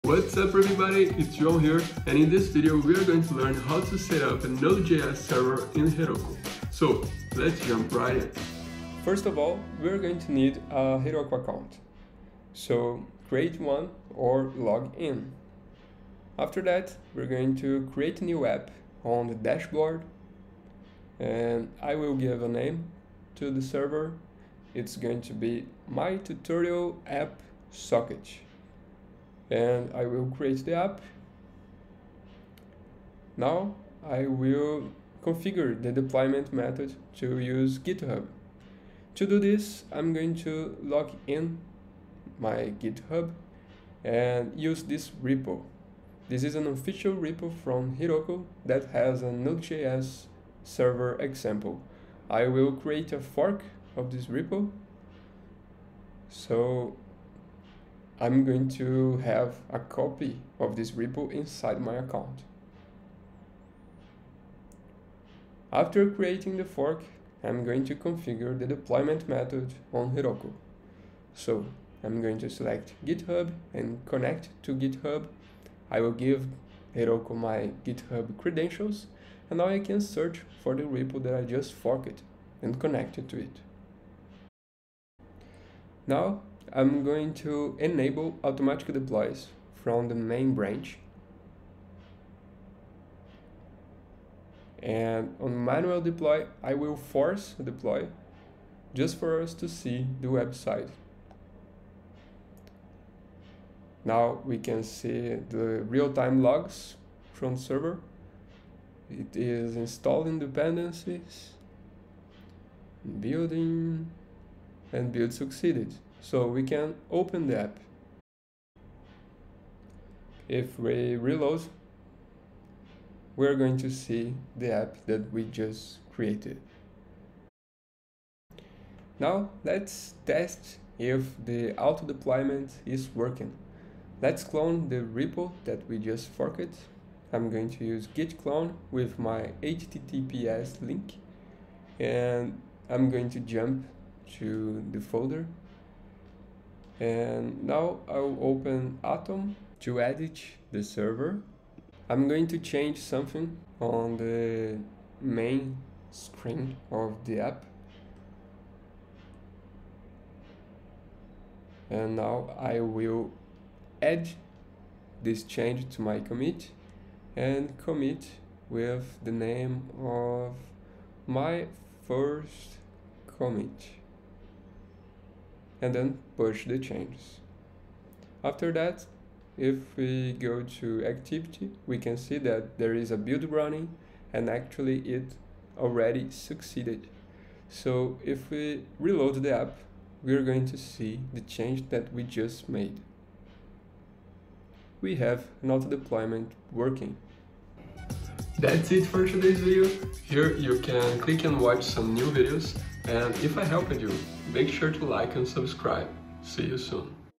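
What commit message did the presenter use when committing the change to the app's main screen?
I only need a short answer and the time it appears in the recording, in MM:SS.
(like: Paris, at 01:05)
my first commit, at 02:51.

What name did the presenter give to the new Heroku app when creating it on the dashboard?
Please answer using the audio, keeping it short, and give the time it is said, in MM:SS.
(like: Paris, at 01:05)
my tutorial app socket, at 00:25.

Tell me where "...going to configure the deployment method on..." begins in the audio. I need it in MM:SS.
01:07.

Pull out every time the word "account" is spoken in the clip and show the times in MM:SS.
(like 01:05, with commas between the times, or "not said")
00:11, 01:01.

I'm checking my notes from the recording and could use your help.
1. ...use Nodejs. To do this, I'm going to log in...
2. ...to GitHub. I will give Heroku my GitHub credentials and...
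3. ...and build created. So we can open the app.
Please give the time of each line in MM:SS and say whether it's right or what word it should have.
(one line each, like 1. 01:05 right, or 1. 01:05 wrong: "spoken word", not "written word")
1. 00:37 wrong: "GitHub", not "Nodejs"
2. 01:14 right
3. 01:54 wrong: "succeeded", not "created".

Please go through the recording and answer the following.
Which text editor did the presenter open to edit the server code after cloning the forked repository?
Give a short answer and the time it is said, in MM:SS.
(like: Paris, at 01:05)
Atom, at 02:29.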